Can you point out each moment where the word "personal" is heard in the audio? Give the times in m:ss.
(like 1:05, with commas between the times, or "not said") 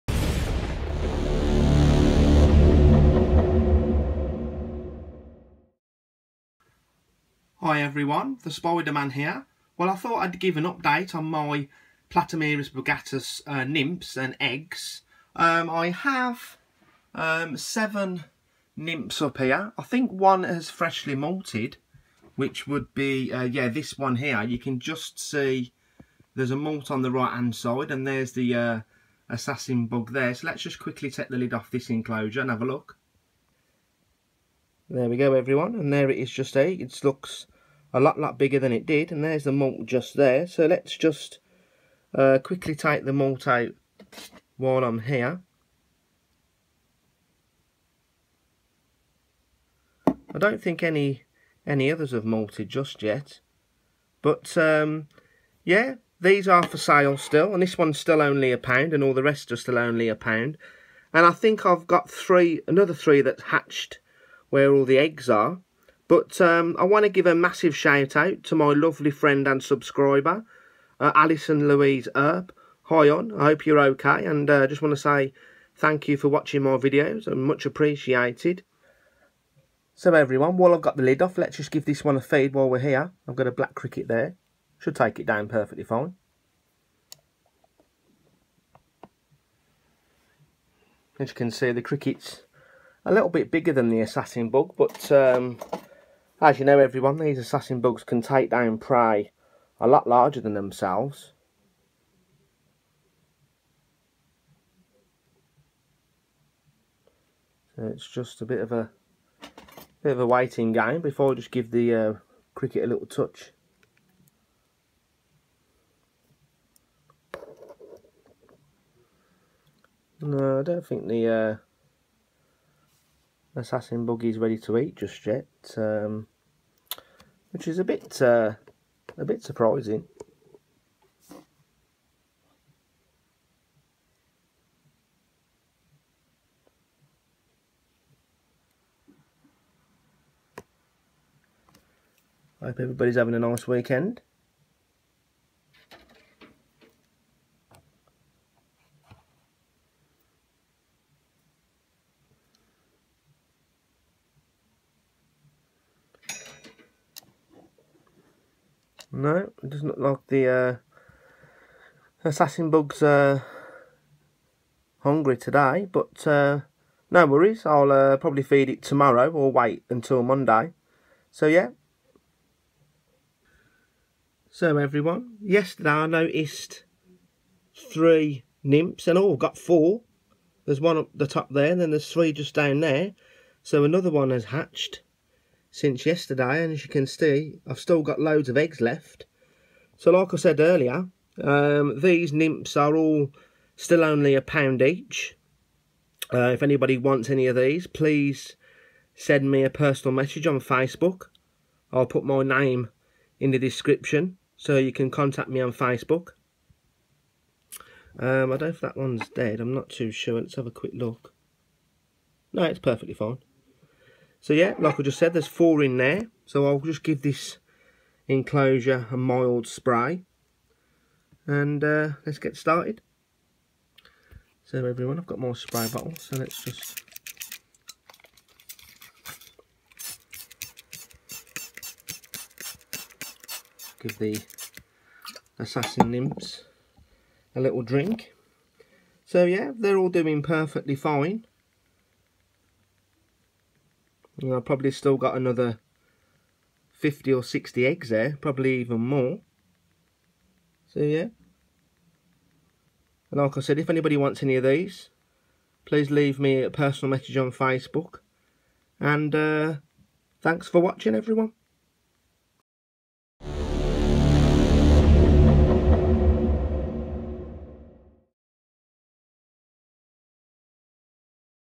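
3:19, 4:16.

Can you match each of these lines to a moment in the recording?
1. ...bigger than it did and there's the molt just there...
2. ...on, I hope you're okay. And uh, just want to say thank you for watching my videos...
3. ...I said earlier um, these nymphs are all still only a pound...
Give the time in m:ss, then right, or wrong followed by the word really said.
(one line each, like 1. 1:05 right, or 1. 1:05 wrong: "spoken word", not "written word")
1. 0:38 right
2. 1:13 right
3. 3:10 right.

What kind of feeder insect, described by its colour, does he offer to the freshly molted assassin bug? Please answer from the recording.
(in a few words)
Black cricket.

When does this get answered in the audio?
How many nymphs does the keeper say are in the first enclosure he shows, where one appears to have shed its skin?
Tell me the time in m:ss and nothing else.
0:17.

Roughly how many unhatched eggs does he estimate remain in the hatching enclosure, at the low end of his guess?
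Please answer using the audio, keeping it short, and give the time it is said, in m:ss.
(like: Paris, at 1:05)
50, at 4:06.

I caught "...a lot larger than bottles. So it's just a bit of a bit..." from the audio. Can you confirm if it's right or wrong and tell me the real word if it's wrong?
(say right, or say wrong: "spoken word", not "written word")
wrong: "themselves", not "bottles".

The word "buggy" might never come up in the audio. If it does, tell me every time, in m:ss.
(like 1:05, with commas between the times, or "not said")
2:04.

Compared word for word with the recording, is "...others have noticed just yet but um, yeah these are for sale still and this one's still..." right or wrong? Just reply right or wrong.
wrong.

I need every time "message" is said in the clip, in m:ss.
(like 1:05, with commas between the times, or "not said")
3:20, 4:17.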